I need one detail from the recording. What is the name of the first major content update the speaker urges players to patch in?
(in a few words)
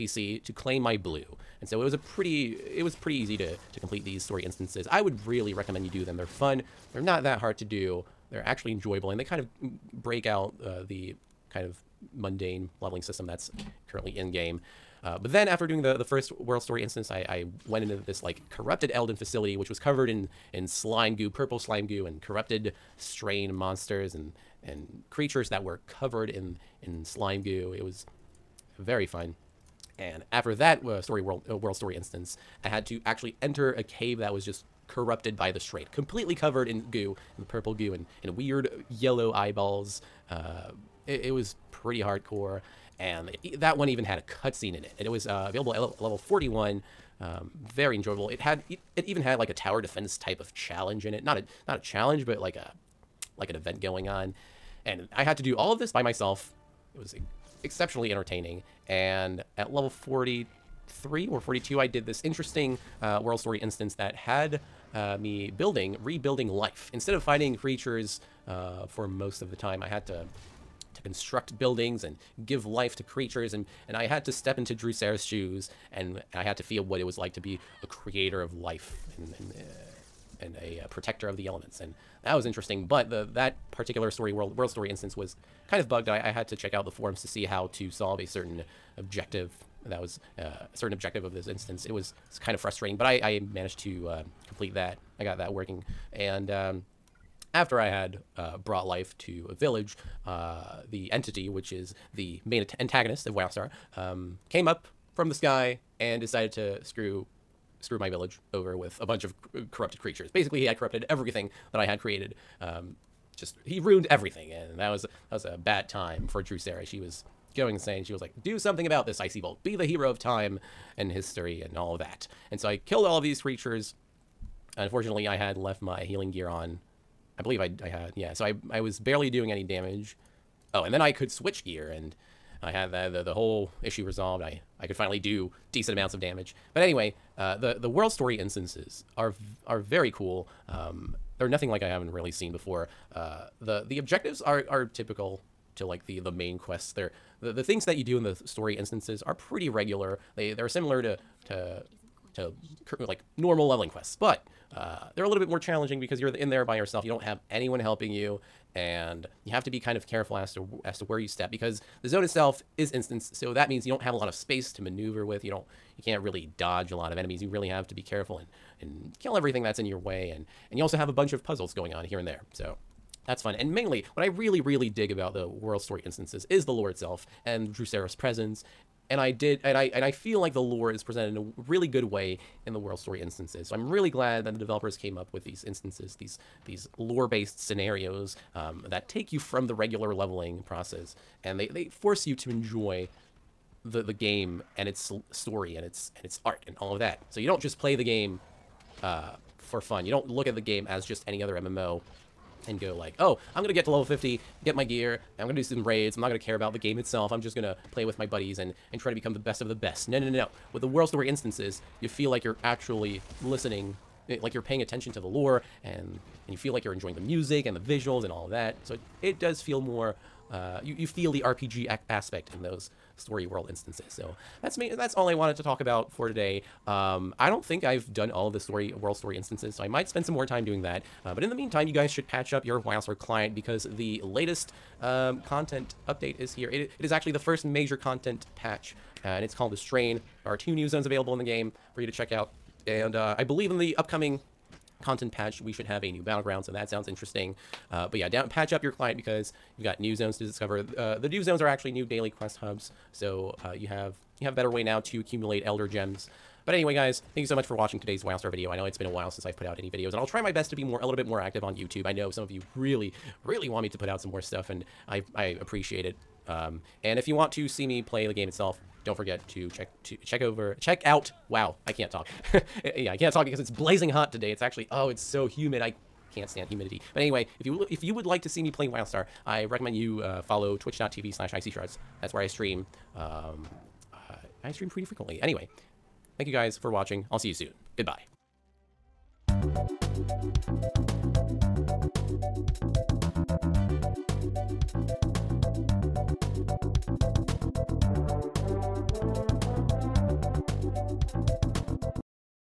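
The Strain.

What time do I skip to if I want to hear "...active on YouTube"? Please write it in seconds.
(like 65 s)
261 s.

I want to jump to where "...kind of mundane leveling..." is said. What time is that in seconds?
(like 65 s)
11 s.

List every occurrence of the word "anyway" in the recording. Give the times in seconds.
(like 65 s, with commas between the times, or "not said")
136 s, 256 s, 277 s, 285 s.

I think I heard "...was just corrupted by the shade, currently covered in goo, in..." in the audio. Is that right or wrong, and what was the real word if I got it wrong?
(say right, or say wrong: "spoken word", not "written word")
wrong: "completely", not "currently".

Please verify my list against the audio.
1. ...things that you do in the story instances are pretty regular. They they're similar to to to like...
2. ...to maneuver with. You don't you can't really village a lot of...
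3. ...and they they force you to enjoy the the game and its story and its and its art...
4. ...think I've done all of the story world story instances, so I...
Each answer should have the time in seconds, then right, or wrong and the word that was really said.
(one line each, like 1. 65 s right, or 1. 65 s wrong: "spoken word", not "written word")
1. 147 s right
2. 164 s wrong: "dodge", not "village"
3. 191 s right
4. 227 s right.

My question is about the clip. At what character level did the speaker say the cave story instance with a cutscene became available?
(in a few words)
41.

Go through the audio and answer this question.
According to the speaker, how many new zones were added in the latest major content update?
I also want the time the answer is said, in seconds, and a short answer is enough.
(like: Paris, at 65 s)
2, at 240 s.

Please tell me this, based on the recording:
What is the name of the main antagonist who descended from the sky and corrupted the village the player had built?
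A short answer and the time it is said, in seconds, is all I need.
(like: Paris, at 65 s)
The Entity, at 100 s.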